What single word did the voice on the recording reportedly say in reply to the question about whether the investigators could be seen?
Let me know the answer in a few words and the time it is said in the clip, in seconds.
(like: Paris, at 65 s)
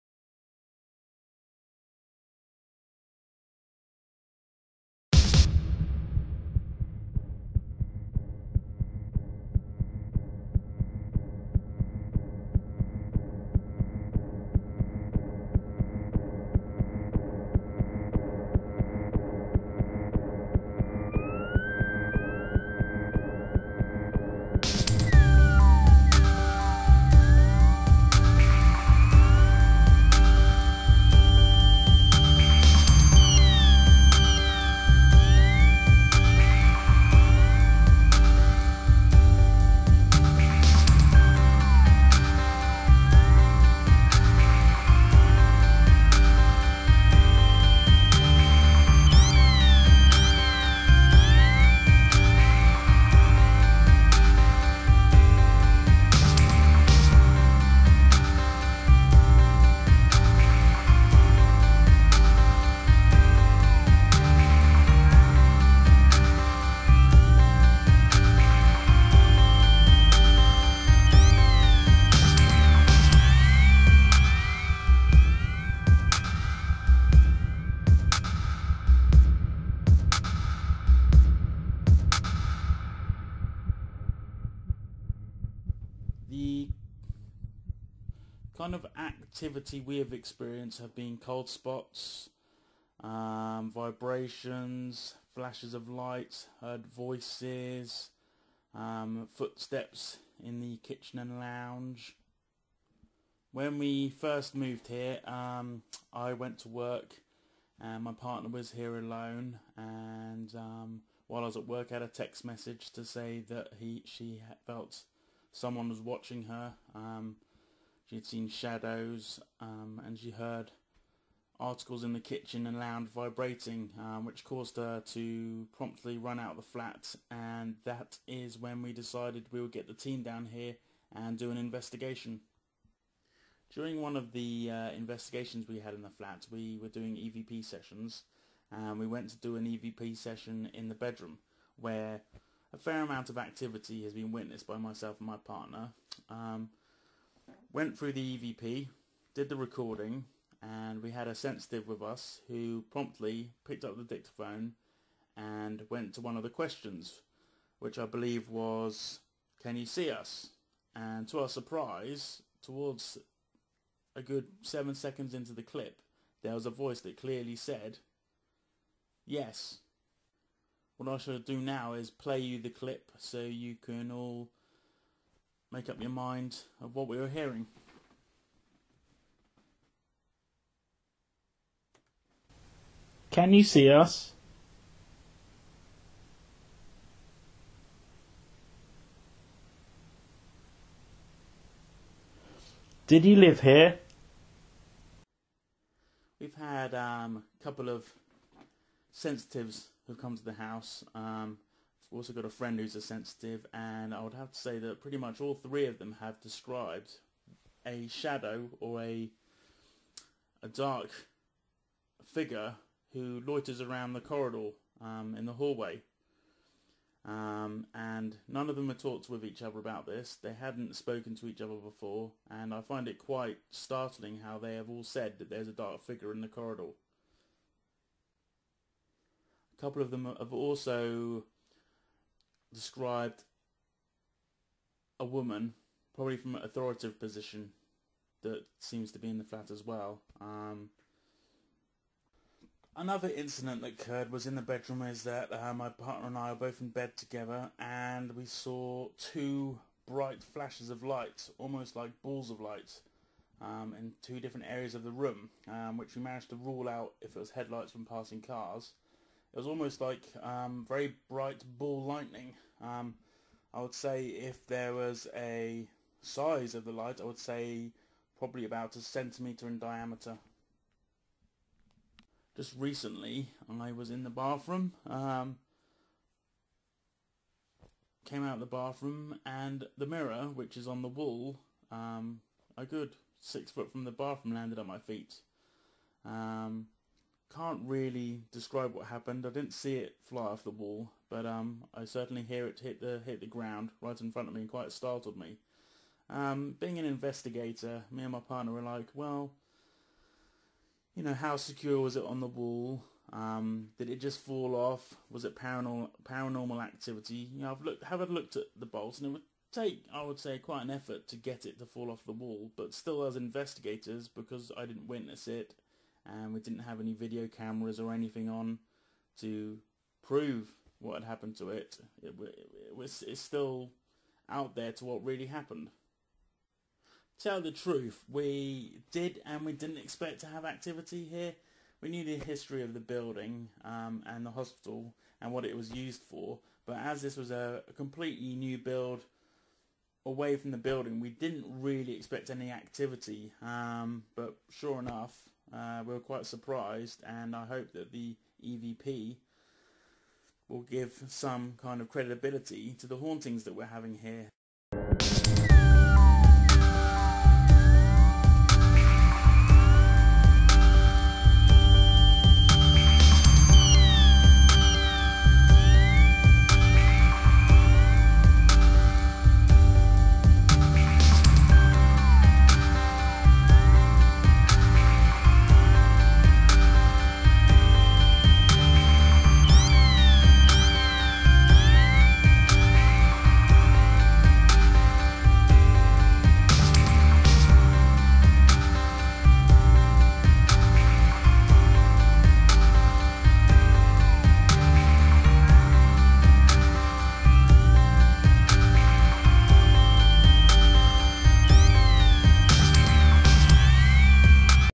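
Yes, at 169 s.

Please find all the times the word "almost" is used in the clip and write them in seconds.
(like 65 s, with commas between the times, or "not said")
251 s, 259 s.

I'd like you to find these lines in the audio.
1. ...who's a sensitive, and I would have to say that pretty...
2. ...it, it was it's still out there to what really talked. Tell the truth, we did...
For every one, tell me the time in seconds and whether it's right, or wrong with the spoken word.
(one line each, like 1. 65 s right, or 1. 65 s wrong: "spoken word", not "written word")
1. 202 s right
2. 322 s wrong: "happened", not "talked".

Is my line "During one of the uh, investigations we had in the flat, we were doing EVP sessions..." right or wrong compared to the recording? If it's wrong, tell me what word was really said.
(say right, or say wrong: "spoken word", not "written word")
right.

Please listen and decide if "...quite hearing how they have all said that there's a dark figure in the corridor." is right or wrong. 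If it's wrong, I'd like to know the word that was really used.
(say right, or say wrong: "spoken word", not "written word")
wrong: "startling", not "hearing".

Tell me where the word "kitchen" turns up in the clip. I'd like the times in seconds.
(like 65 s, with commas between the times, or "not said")
100 s, 122 s.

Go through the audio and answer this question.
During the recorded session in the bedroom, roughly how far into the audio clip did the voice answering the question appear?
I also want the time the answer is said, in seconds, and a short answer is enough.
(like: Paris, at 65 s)
7 seconds, at 164 s.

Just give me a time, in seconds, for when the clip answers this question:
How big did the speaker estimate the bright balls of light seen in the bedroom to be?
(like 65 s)
268 s.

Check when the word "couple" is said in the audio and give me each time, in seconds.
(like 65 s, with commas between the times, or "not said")
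197 s, 229 s.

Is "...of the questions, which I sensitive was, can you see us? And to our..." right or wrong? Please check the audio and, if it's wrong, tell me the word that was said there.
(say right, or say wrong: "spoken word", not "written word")
wrong: "believe", not "sensitive".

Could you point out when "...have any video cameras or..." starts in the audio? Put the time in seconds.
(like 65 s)
316 s.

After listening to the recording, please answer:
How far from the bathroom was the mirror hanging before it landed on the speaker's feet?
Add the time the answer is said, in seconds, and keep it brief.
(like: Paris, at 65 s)
6 feet, at 283 s.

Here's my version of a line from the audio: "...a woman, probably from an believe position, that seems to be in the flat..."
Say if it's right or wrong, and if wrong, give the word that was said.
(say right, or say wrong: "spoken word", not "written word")
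wrong: "authoritative", not "believe".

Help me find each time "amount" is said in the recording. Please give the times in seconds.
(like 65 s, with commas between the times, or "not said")
143 s.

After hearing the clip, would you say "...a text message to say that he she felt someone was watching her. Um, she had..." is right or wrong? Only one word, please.
right.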